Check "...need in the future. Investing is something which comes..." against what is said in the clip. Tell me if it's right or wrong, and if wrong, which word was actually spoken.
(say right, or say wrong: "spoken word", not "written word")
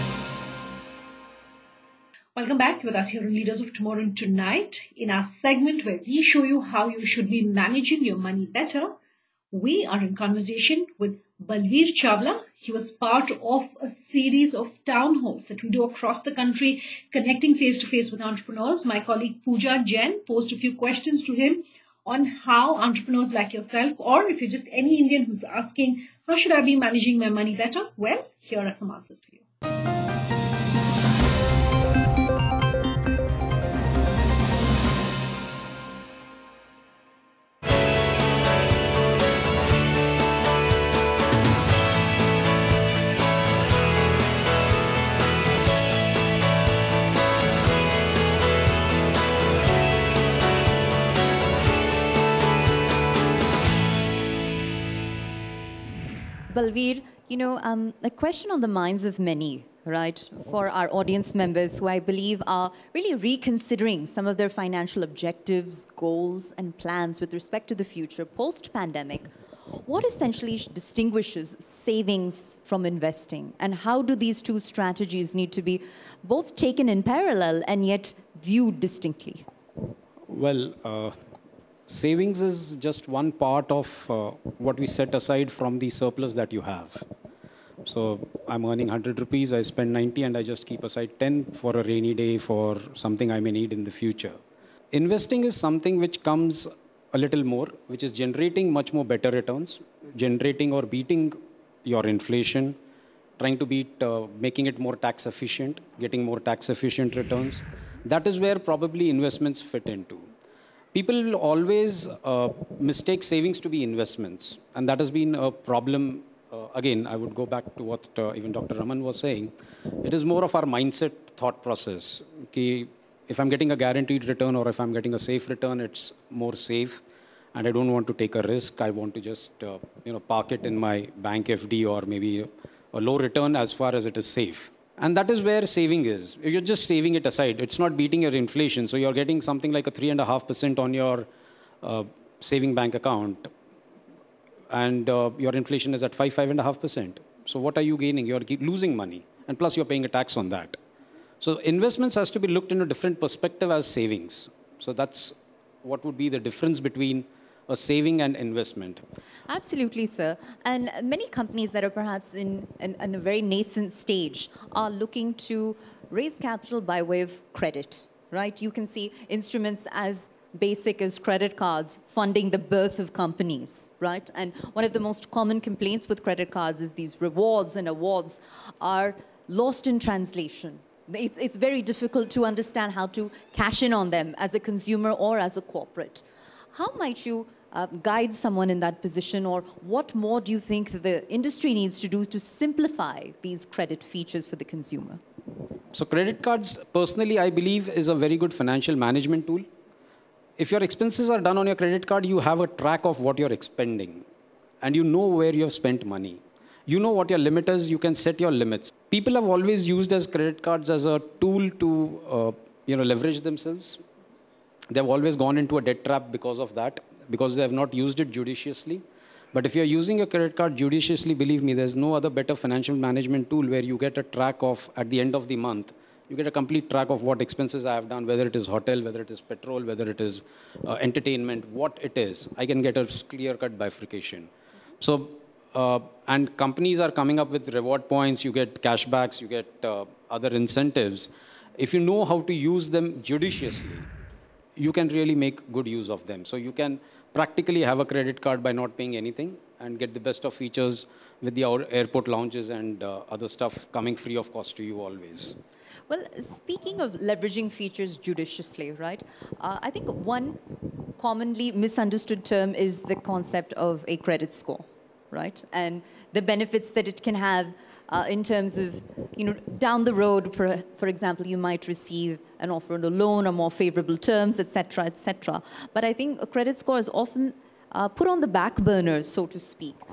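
right.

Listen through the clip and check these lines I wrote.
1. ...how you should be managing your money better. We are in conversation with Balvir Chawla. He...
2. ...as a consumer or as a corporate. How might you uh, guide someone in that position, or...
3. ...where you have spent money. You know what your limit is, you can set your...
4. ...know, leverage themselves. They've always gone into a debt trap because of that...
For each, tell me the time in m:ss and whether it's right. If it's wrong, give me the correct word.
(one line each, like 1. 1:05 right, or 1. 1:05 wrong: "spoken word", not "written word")
1. 0:06 right
2. 3:04 right
3. 3:25 right
4. 3:32 right.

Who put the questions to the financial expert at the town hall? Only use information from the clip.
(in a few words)
Pooja Jain.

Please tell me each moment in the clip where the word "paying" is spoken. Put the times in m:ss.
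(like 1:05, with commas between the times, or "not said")
2:29, 4:08.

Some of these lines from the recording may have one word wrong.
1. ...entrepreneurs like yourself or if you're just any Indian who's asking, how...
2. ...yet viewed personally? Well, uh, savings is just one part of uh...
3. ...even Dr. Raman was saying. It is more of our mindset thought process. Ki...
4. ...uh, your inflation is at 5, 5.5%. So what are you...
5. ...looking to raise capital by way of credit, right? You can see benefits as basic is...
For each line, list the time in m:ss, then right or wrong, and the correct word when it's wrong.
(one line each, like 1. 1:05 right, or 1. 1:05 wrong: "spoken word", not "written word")
1. 0:22 right
2. 1:17 wrong: "distinctly", not "personally"
3. 1:58 right
4. 2:25 right
5. 2:44 wrong: "instruments", not "benefits".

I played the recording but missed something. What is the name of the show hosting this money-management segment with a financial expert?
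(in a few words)
Leaders of Tomorrow.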